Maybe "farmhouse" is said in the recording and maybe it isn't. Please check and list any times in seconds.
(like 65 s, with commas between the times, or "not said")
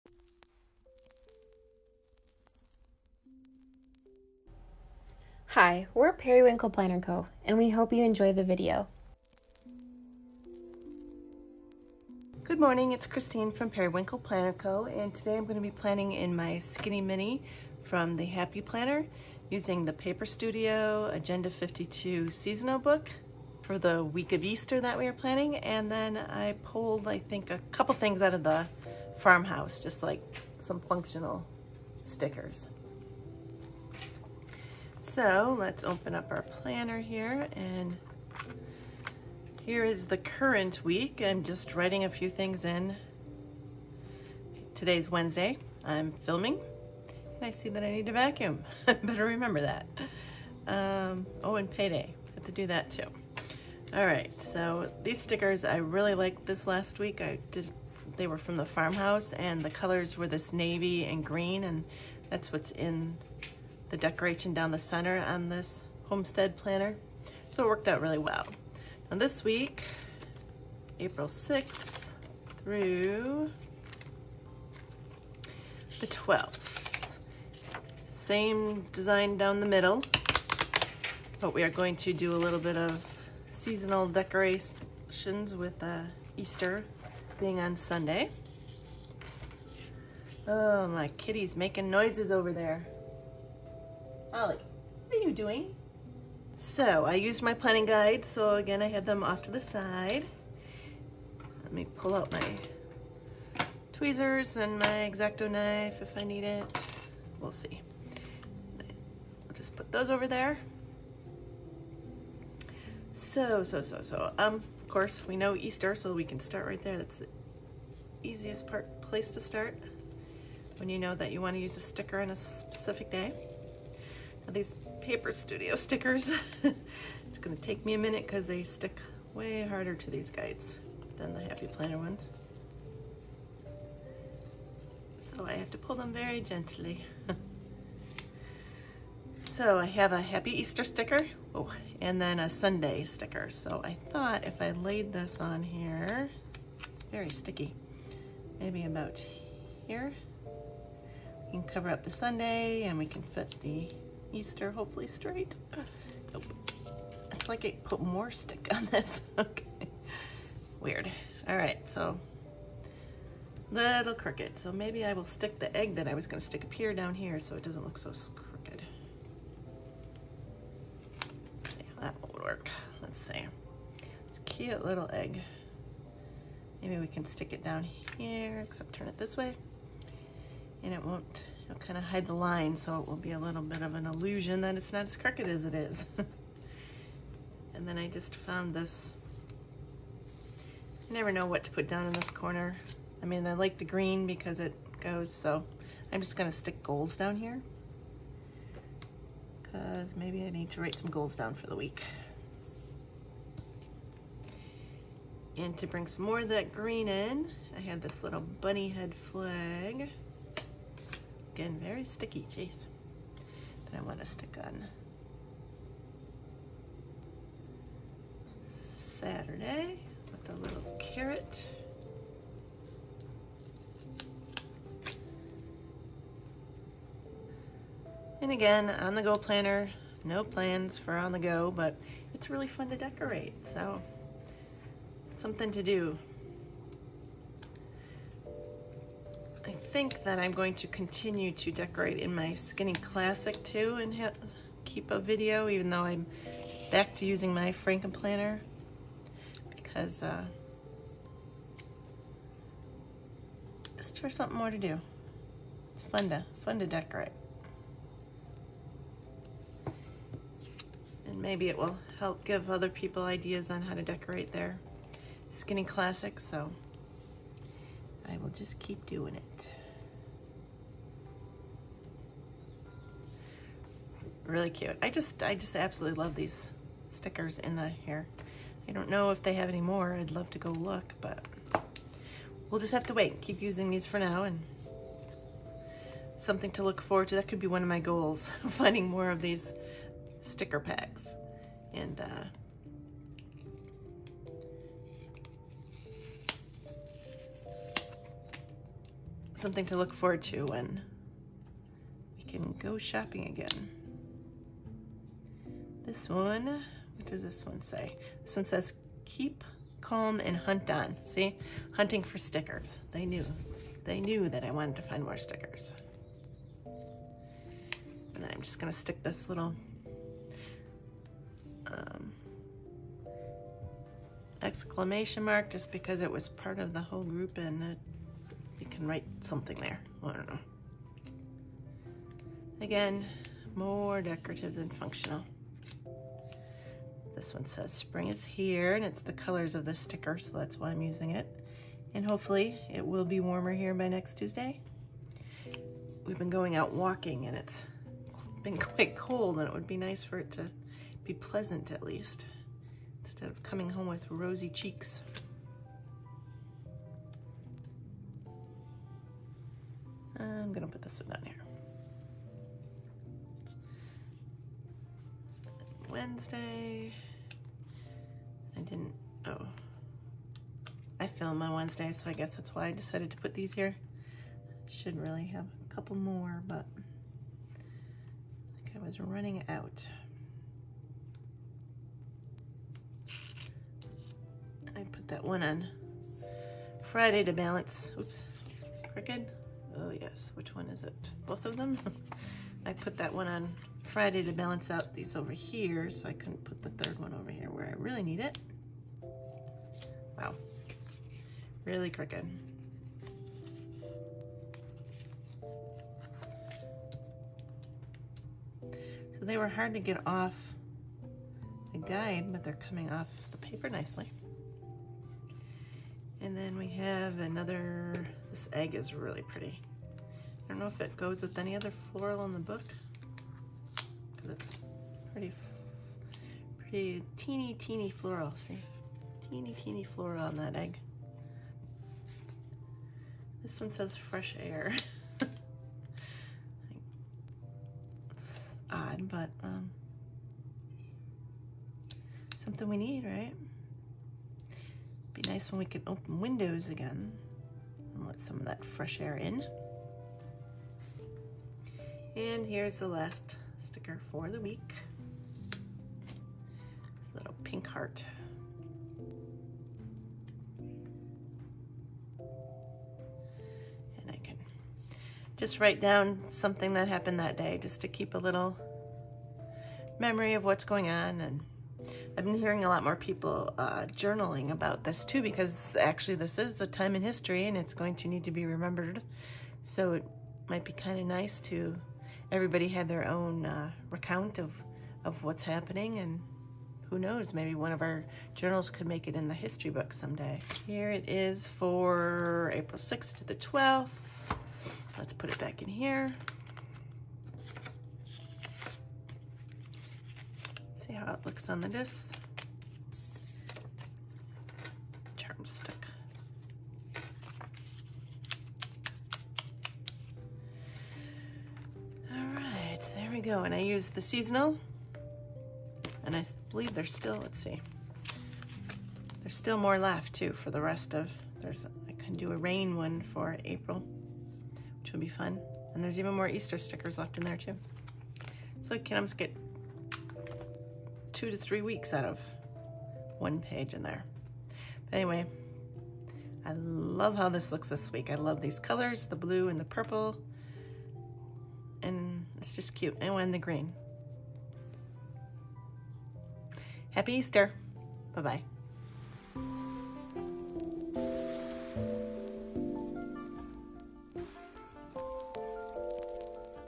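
29 s, 58 s.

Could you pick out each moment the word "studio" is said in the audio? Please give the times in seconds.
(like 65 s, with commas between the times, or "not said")
20 s, 125 s.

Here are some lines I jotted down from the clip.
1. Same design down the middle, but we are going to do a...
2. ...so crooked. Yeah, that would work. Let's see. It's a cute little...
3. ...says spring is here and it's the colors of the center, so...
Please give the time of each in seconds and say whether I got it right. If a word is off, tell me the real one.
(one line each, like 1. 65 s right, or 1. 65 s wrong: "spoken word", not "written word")
1. 78 s right
2. 167 s right
3. 337 s wrong: "sticker", not "center".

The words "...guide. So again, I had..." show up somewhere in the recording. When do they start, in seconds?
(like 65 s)
97 s.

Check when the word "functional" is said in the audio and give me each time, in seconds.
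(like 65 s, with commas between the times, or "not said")
30 s, 334 s.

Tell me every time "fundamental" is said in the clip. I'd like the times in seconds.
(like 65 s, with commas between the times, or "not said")
not said.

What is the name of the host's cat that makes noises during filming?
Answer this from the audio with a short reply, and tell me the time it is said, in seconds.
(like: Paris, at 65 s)
Ollie, at 94 s.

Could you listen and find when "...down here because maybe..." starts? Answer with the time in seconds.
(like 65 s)
197 s.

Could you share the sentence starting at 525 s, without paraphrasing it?
And there's even more Easter stickers left in there too.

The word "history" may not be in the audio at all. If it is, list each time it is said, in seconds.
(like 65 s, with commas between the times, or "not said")
477 s, 489 s.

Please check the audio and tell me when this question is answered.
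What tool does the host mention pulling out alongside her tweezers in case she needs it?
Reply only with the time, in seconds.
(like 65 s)
105 s.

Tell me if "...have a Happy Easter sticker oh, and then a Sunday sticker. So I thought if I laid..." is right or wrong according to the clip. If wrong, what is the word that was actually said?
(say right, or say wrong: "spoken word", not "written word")
right.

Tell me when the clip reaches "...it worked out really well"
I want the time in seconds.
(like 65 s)
67 s.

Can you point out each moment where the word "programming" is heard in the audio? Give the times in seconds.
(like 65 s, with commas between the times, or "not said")
not said.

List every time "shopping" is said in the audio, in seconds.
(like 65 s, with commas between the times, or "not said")
302 s.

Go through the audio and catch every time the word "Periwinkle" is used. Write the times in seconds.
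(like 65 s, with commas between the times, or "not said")
6 s, 13 s.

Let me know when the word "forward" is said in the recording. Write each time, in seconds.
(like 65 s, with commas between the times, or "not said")
287 s, 300 s.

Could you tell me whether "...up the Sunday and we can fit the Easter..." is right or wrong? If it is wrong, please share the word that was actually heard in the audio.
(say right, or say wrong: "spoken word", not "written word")
right.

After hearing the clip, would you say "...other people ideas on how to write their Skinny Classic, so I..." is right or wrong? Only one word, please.
wrong.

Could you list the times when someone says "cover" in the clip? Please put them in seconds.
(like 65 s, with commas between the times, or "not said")
151 s.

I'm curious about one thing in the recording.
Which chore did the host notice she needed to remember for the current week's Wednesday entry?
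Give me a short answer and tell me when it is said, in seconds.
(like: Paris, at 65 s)
vacuum, at 48 s.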